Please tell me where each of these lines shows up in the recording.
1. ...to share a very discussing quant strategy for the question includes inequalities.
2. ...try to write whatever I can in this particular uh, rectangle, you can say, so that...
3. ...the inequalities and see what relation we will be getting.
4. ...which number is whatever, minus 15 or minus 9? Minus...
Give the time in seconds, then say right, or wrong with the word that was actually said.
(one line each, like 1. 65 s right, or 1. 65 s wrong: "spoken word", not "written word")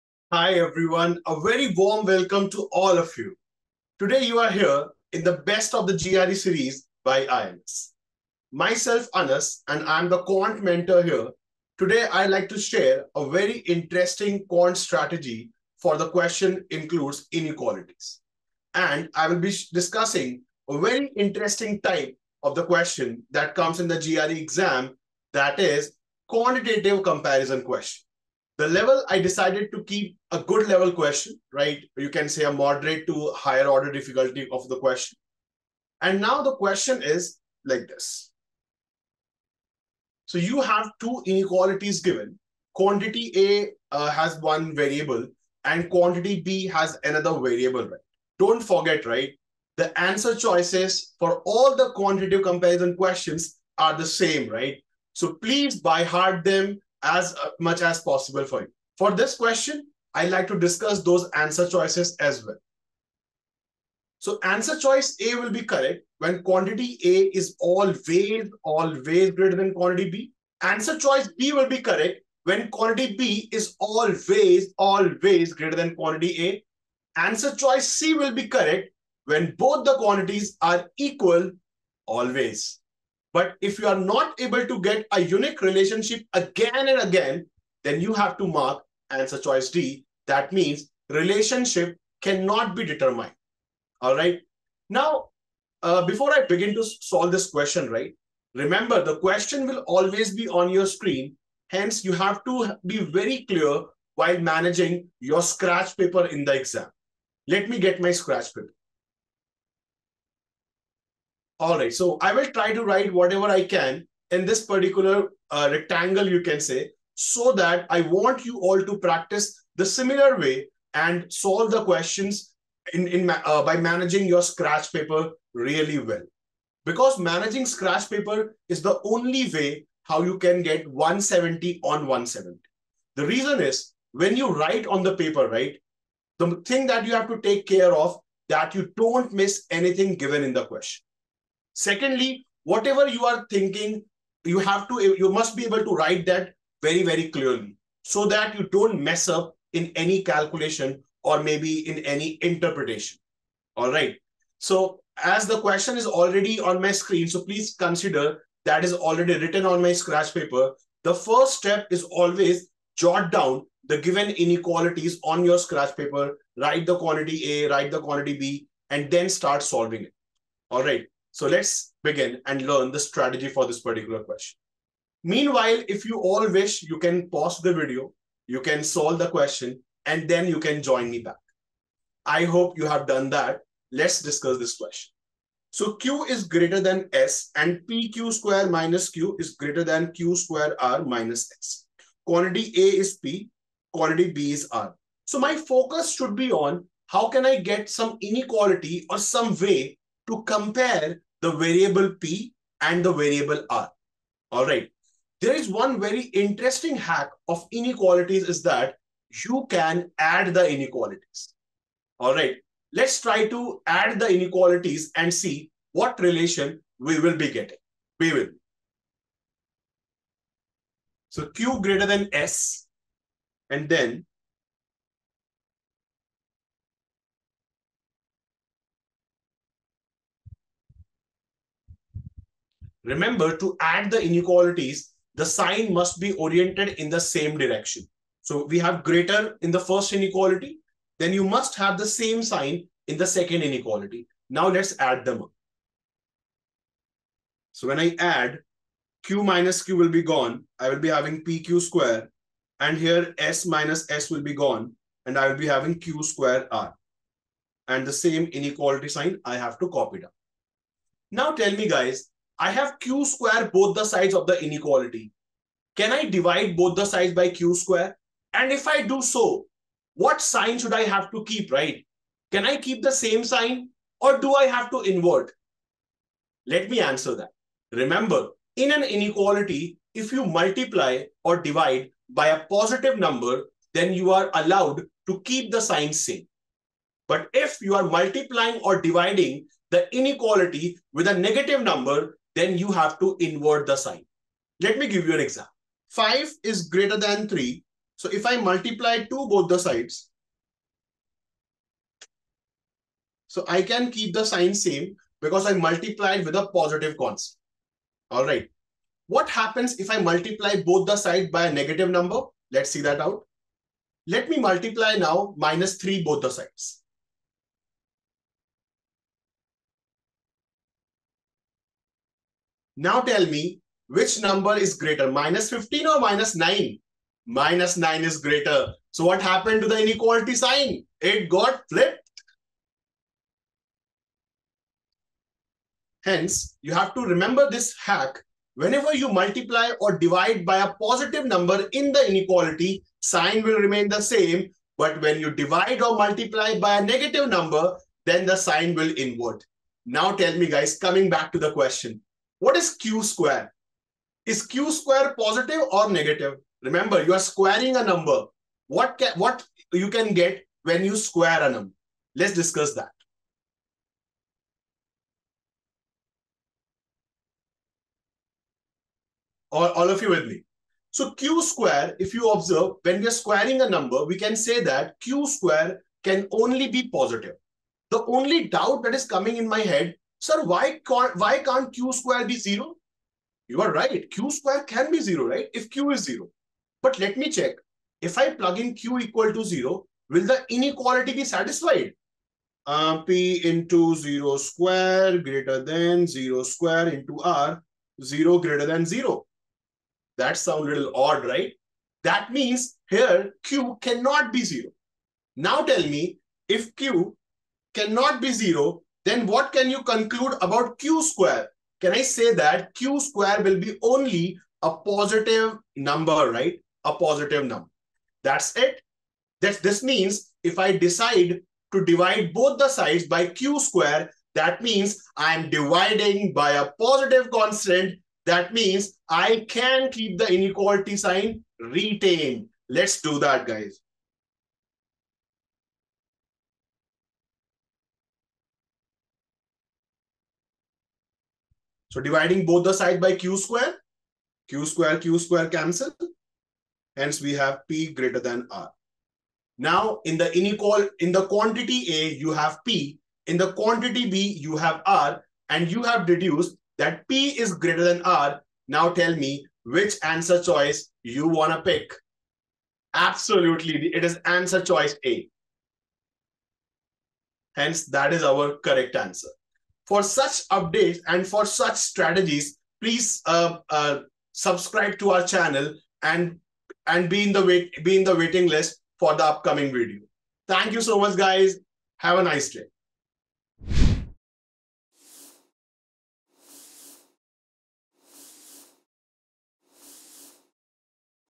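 1. 12 s wrong: "interesting", not "discussing"
2. 112 s right
3. 214 s right
4. 324 s wrong: "greater", not "whatever".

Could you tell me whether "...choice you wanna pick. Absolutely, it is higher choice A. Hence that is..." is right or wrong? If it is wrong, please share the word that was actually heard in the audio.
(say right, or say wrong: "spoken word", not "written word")
wrong: "answer", not "higher".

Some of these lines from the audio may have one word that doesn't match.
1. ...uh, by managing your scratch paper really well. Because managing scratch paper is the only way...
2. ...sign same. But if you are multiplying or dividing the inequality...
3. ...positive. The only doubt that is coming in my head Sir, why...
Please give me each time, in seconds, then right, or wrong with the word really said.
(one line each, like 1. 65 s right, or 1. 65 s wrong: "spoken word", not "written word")
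1. 123 s right
2. 285 s right
3. 377 s right.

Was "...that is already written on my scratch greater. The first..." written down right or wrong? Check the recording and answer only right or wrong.
wrong.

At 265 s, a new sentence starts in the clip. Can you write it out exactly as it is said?
Can I divide both the sides by q square?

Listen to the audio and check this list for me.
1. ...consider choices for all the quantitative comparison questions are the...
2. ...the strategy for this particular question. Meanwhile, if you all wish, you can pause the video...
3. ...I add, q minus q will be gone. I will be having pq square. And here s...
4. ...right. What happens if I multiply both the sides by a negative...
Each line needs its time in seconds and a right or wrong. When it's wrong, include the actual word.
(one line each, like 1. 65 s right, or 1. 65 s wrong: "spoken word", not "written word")
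1. 49 s wrong: "answer", not "consider"
2. 172 s right
3. 247 s right
4. 308 s right.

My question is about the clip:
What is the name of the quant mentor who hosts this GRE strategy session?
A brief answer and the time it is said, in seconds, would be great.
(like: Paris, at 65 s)
Anas, at 9 s.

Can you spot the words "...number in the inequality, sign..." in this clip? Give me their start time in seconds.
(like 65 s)
341 s.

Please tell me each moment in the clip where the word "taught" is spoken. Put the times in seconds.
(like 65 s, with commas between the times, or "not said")
not said.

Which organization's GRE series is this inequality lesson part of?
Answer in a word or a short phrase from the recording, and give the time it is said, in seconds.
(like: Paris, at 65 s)
IMS, at 7 s.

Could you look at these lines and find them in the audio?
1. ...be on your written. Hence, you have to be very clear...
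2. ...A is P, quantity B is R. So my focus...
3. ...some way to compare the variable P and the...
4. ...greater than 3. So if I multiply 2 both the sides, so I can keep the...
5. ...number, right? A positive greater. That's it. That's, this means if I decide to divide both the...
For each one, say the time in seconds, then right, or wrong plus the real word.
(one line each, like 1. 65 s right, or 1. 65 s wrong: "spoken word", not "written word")
1. 100 s wrong: "screen", not "written"
2. 192 s right
3. 199 s right
4. 296 s right
5. 415 s wrong: "number", not "greater".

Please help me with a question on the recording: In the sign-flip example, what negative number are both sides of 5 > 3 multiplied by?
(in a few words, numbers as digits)
-3.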